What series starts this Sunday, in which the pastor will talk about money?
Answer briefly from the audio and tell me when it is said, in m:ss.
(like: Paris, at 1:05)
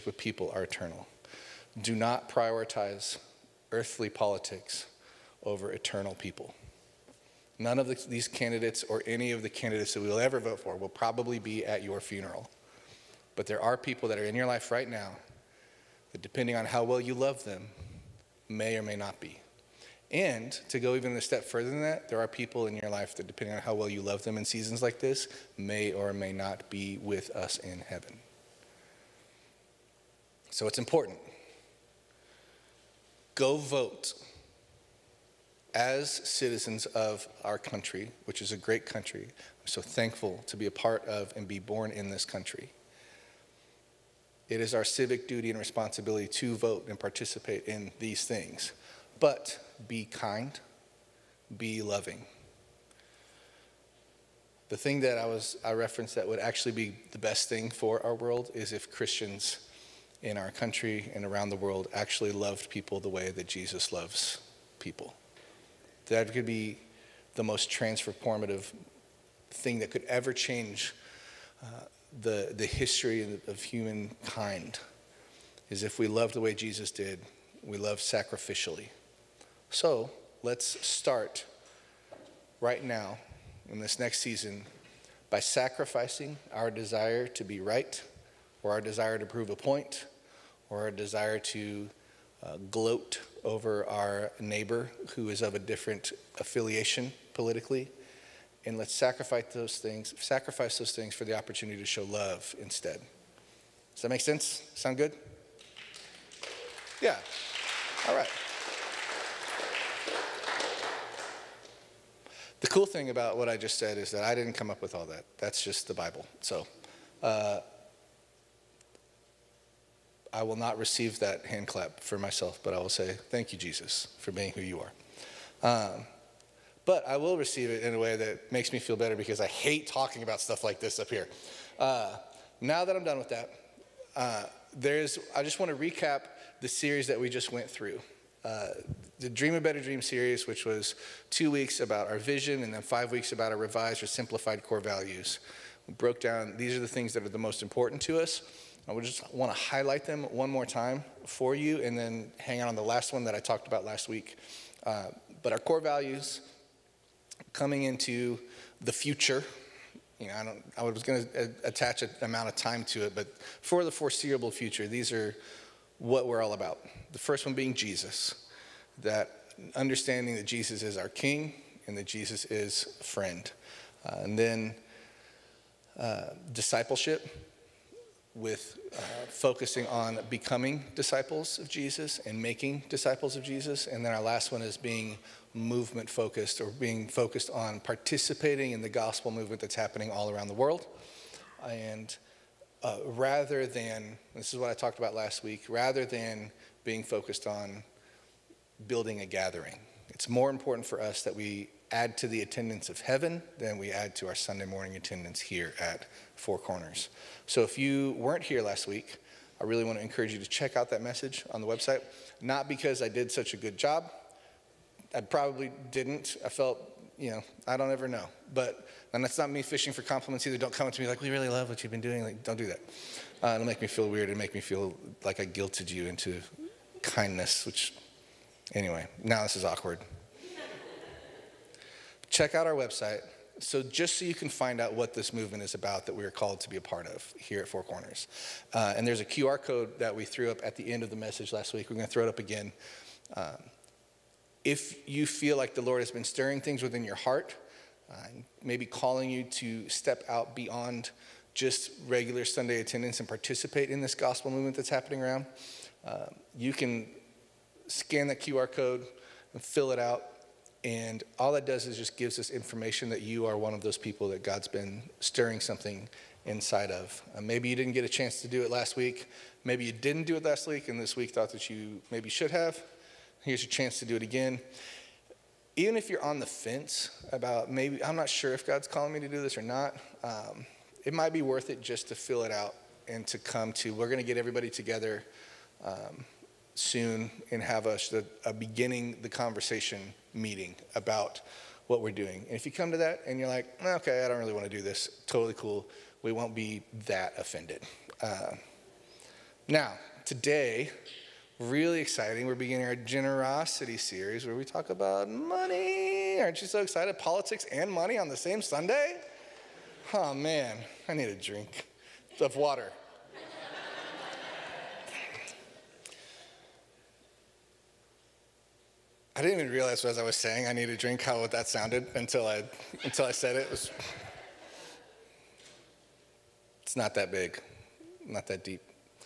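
generosity series, at 5:02.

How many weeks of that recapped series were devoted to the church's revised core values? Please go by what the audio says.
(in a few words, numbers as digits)
5.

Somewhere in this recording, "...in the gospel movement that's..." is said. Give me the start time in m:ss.
3:08.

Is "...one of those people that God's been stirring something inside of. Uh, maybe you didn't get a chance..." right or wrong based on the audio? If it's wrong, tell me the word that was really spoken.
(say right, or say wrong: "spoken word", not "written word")
right.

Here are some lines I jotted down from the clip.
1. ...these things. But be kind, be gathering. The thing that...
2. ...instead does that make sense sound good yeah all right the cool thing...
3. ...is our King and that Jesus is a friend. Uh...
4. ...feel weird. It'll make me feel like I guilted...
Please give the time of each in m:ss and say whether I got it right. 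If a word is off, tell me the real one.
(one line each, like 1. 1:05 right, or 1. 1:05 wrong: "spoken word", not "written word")
1. 0:47 wrong: "loving", not "gathering"
2. 1:42 right
3. 2:50 right
4. 3:43 right.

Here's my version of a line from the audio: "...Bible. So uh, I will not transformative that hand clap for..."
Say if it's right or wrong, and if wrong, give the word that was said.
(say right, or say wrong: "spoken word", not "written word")
wrong: "receive", not "transformative".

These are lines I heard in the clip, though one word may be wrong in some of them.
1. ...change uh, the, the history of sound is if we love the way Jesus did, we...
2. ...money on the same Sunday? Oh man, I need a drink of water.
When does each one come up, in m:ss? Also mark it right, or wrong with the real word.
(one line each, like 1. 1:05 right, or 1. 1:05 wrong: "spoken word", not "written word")
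1. 1:10 wrong: "humankind", not "sound"
2. 5:07 right.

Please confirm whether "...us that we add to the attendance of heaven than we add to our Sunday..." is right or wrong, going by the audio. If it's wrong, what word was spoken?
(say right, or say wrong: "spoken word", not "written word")
right.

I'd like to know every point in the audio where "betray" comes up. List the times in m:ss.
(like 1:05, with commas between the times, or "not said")
not said.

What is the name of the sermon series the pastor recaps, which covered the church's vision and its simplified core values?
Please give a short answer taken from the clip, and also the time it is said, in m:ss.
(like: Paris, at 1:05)
Dream a Better Dream, at 2:19.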